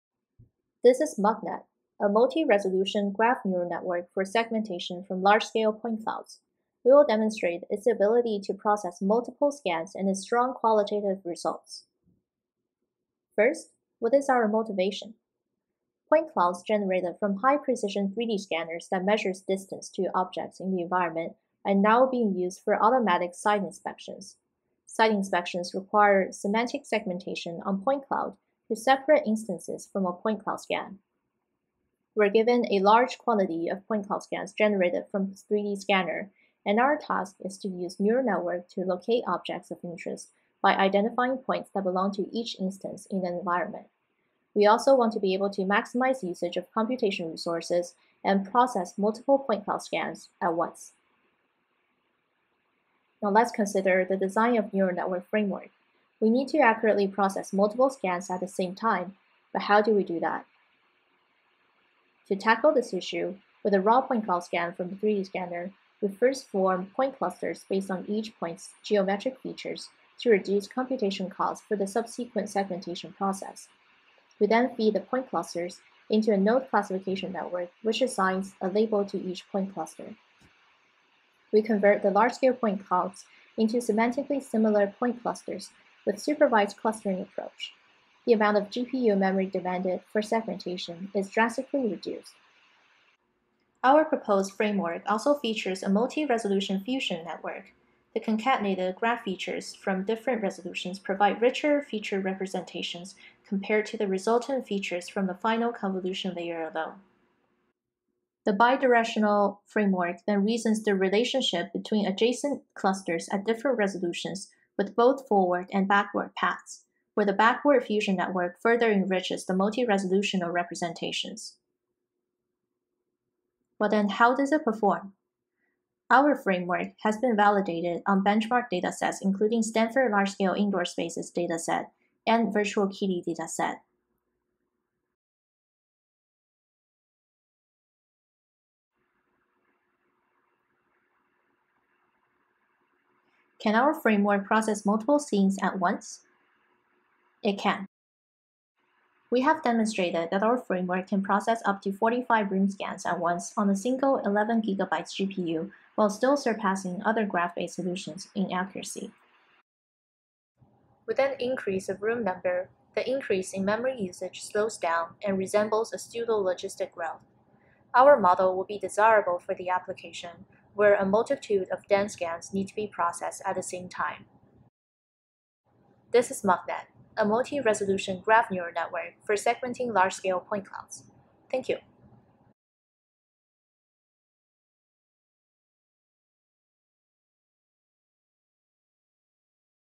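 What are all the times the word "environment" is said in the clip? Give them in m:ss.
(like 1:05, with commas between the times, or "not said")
0:20, 0:43.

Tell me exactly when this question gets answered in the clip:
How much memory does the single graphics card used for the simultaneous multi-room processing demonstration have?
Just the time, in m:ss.
2:34.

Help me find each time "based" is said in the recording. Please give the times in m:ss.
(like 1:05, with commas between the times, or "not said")
1:07, 2:37.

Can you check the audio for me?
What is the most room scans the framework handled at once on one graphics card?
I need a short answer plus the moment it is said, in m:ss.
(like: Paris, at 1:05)
45, at 2:31.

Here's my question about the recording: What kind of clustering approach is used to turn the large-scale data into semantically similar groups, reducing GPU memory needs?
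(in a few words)
supervised clustering.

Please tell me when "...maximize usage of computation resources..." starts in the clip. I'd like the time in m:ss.
0:45.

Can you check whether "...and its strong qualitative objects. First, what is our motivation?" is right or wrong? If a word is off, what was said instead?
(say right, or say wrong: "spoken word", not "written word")
wrong: "results", not "objects".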